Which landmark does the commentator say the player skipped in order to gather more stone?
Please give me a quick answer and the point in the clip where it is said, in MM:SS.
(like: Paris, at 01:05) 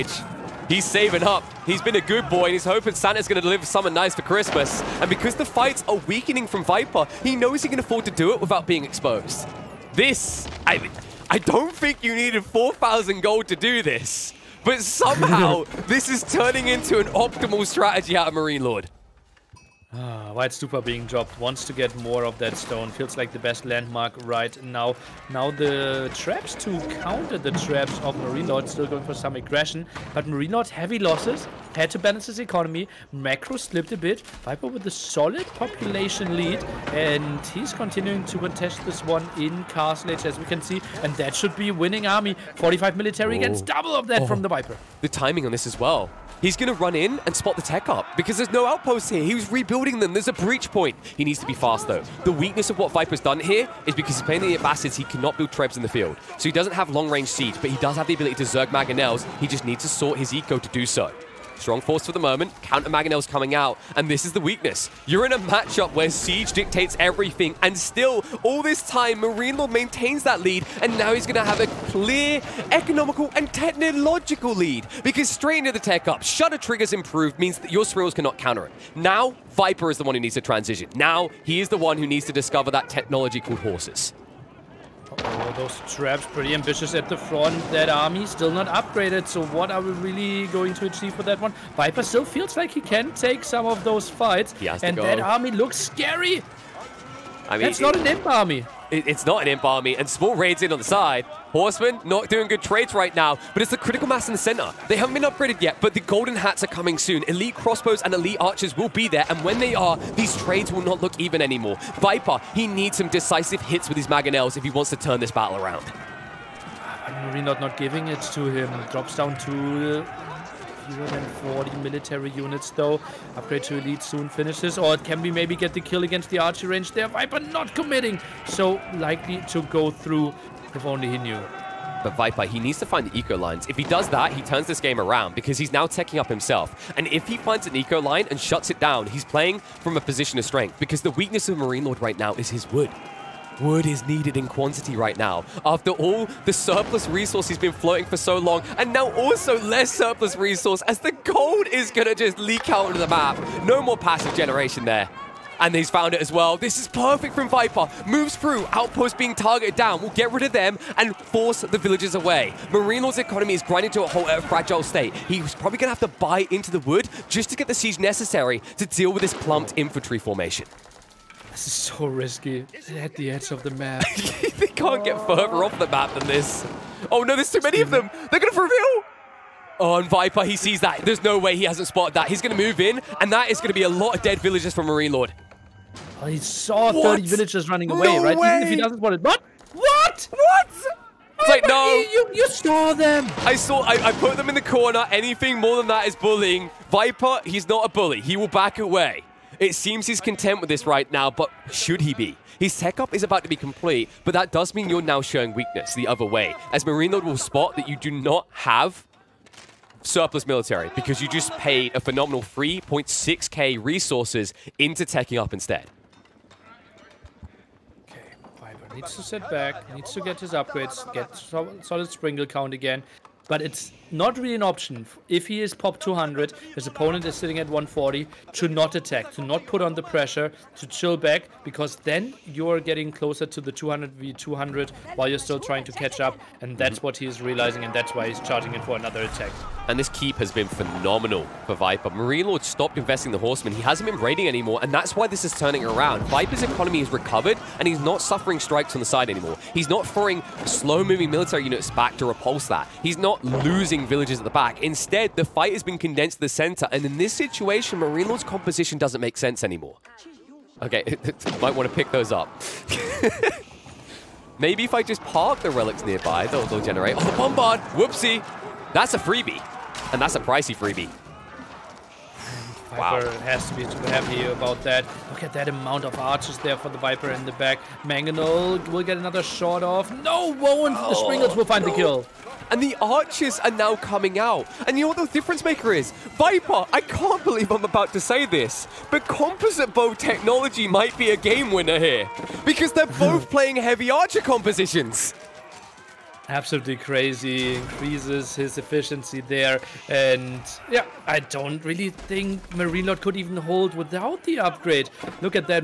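White Stupa, at 00:20.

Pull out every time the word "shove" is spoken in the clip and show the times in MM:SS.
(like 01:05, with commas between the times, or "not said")
not said.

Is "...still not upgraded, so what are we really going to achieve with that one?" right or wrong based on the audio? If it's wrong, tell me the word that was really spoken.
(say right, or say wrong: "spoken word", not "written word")
right.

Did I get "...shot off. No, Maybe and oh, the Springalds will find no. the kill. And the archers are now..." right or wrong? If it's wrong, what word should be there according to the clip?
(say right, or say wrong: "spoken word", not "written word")
wrong: "Woe", not "Maybe".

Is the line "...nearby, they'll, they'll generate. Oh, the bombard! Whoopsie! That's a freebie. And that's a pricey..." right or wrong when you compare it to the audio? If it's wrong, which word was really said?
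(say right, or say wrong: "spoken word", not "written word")
right.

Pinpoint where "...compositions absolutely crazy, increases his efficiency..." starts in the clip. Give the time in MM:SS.
04:54.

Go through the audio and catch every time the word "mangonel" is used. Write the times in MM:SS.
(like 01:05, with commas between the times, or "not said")
00:58, 01:02, 01:54, 04:38.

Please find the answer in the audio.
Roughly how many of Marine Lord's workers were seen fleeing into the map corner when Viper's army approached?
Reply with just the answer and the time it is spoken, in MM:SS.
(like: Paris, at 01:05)
30, at 03:07.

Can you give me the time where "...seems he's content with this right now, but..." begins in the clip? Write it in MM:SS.
03:19.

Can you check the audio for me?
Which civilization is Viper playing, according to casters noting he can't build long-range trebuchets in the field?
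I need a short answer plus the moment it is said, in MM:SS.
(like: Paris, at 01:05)
Abbasids, at 00:54.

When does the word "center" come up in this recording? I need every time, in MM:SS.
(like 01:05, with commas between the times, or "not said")
01:44, 04:16.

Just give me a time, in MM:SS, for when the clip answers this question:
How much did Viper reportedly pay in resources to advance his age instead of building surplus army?
03:32.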